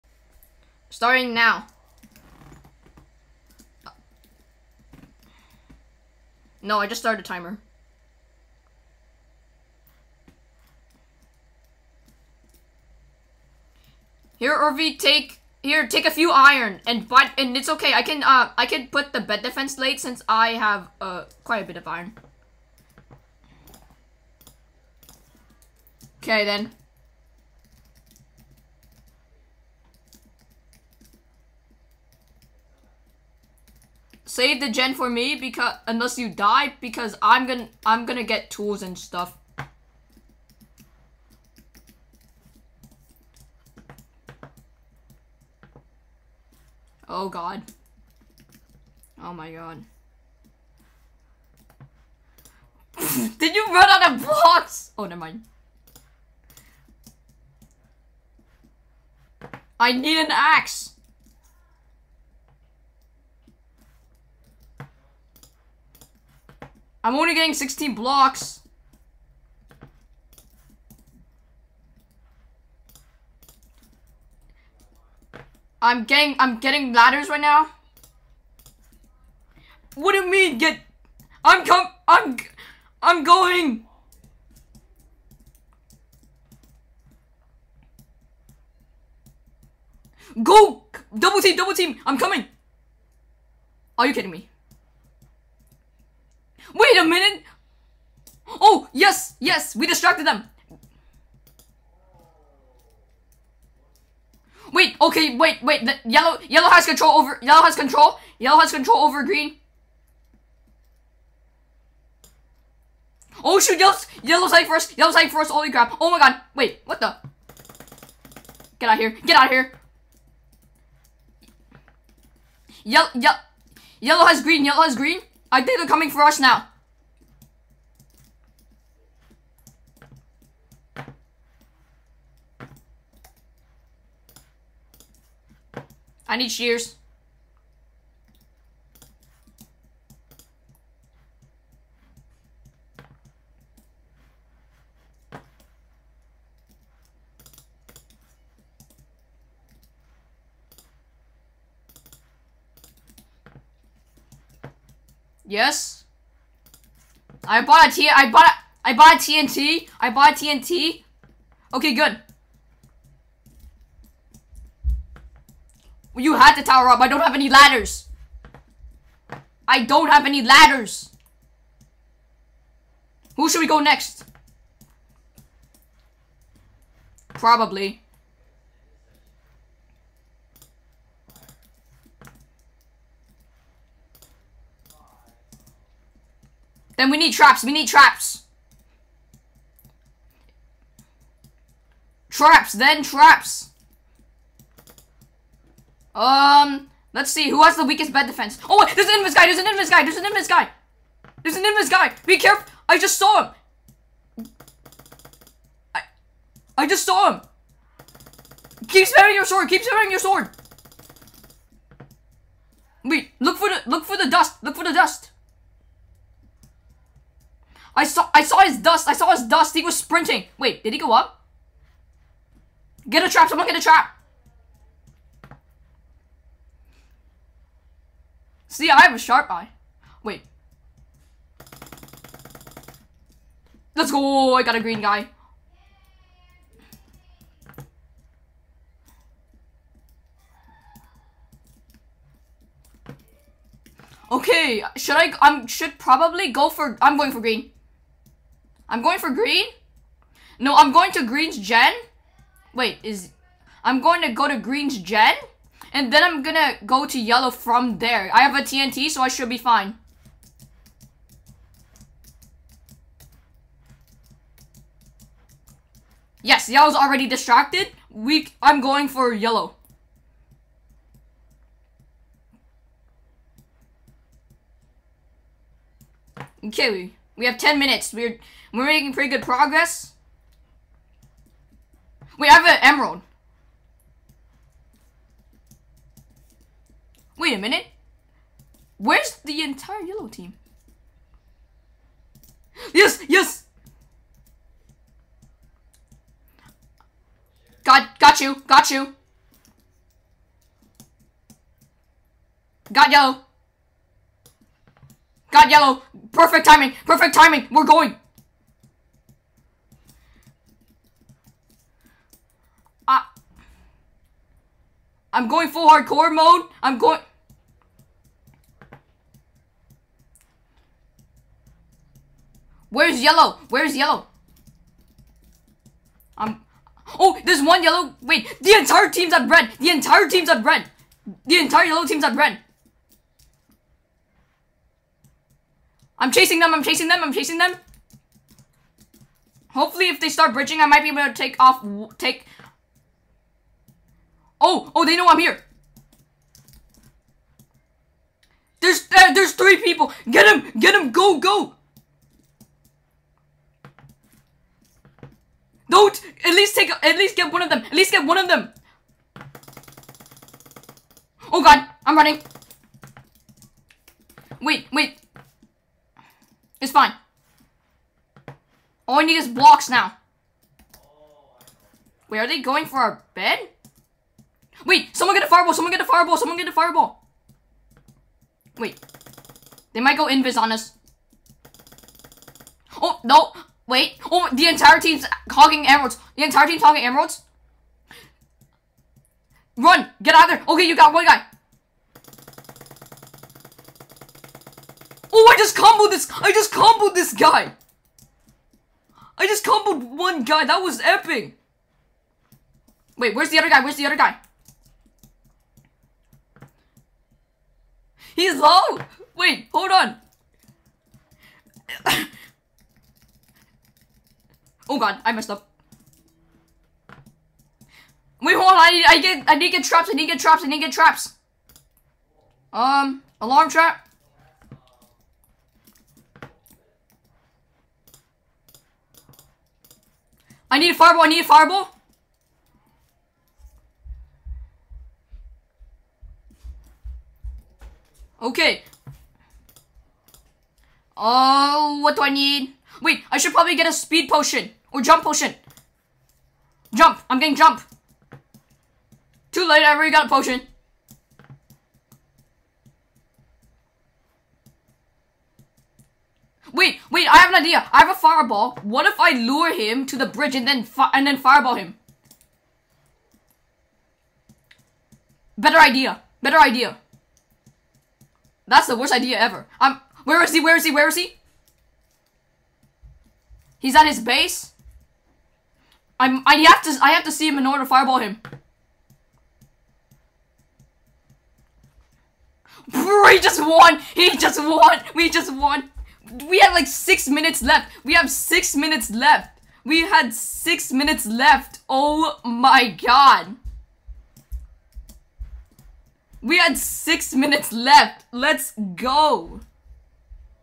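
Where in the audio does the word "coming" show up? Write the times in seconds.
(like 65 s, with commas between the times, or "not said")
92 s, 125 s.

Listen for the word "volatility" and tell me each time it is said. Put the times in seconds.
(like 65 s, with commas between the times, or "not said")
not said.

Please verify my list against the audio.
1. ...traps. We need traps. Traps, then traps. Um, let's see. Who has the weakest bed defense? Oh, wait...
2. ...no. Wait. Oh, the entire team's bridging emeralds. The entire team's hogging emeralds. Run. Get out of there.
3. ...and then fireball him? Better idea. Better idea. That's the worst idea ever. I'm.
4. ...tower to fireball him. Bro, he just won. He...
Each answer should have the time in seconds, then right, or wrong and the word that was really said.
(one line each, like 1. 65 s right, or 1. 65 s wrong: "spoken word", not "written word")
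1. 187 s right
2. 383 s wrong: "hogging", not "bridging"
3. 461 s right
4. 477 s wrong: "order", not "tower".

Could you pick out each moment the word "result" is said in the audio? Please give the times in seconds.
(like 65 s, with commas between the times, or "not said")
not said.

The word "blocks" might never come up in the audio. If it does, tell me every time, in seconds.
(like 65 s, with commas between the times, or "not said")
54 s, 67 s, 369 s.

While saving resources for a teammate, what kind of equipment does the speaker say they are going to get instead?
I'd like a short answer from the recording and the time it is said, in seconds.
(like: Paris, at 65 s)
tools, at 38 s.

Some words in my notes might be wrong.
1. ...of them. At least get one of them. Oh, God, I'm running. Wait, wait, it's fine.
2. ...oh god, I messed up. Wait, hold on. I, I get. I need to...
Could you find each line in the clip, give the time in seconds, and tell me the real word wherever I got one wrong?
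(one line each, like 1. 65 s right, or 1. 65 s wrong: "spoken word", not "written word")
1. 357 s right
2. 414 s right.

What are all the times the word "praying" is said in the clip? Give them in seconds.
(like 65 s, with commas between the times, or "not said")
not said.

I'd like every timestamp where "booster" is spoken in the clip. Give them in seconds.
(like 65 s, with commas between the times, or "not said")
not said.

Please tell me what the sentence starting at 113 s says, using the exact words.
Oh shoot, yellow's, yellow's for first, yellow's for first, holy crap, oh my god, wait, what the?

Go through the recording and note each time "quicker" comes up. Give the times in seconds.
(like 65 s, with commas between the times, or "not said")
not said.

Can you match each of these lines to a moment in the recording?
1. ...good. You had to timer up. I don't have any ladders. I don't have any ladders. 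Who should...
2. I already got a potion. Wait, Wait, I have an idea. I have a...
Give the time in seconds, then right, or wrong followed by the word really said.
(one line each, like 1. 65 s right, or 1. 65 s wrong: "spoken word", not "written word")
1. 161 s wrong: "tower", not "timer"
2. 449 s right.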